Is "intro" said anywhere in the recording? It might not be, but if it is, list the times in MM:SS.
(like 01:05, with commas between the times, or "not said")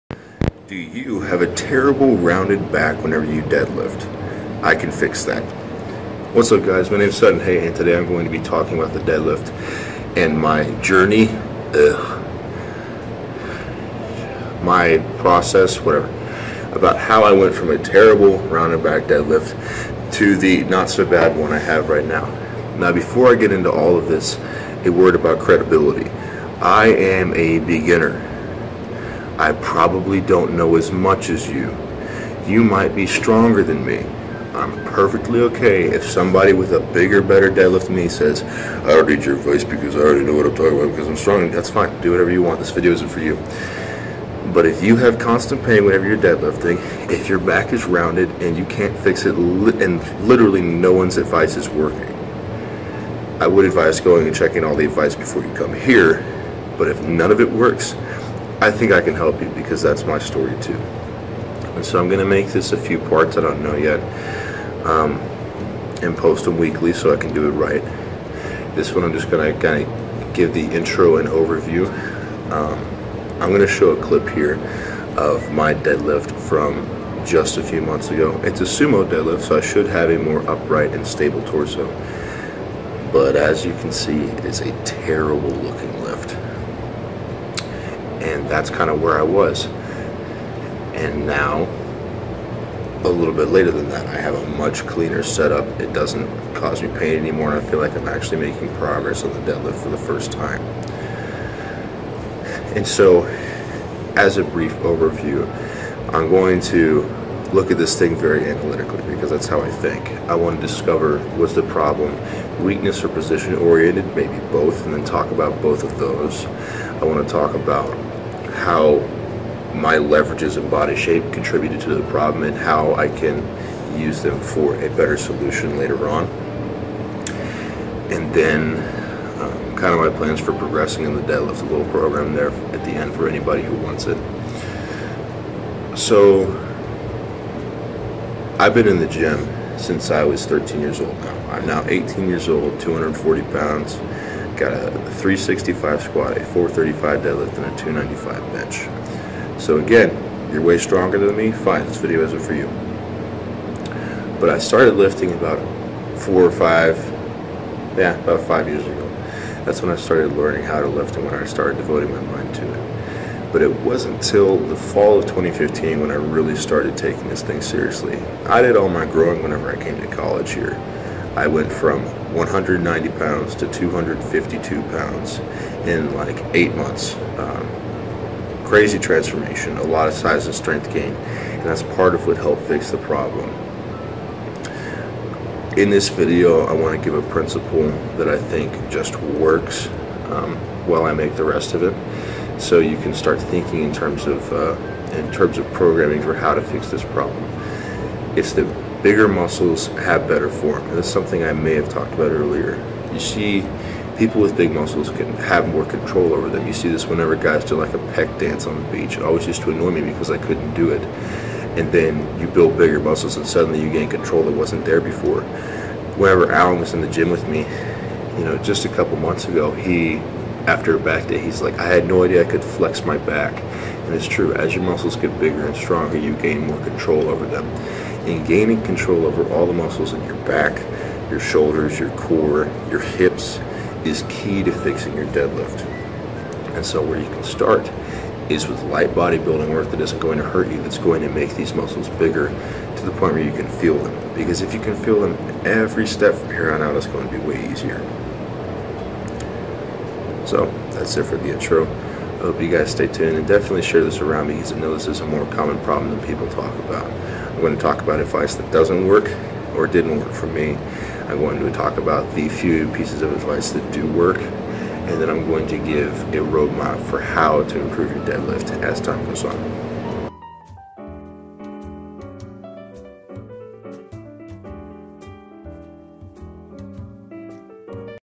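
01:10, 04:11.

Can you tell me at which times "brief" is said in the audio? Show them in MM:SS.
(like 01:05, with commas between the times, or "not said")
01:44.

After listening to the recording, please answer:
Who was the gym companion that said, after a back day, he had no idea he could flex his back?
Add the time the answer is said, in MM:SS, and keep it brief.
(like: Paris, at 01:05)
Alan, at 03:36.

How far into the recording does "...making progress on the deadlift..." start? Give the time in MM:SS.
01:38.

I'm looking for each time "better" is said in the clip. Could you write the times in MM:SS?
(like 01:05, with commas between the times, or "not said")
00:37, 02:04, 03:20.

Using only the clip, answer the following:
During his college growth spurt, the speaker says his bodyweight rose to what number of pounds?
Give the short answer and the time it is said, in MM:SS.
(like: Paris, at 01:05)
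252, at 02:53.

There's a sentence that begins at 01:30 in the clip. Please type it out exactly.
And now, a little bit later than that, I have a much cleaner setup.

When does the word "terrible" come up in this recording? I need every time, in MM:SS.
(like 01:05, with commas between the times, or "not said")
00:01, 00:17, 01:24.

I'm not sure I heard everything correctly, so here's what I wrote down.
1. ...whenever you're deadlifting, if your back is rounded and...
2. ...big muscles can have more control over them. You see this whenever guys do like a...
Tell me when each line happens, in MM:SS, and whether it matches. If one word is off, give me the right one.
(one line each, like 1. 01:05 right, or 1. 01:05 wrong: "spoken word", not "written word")
1. 00:45 right
2. 03:24 right.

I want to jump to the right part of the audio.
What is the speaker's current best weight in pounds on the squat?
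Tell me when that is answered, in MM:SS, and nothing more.
02:24.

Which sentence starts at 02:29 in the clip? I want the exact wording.
So again, you're way stronger than me, fine, this video isn't for you.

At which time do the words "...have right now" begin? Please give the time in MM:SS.
00:21.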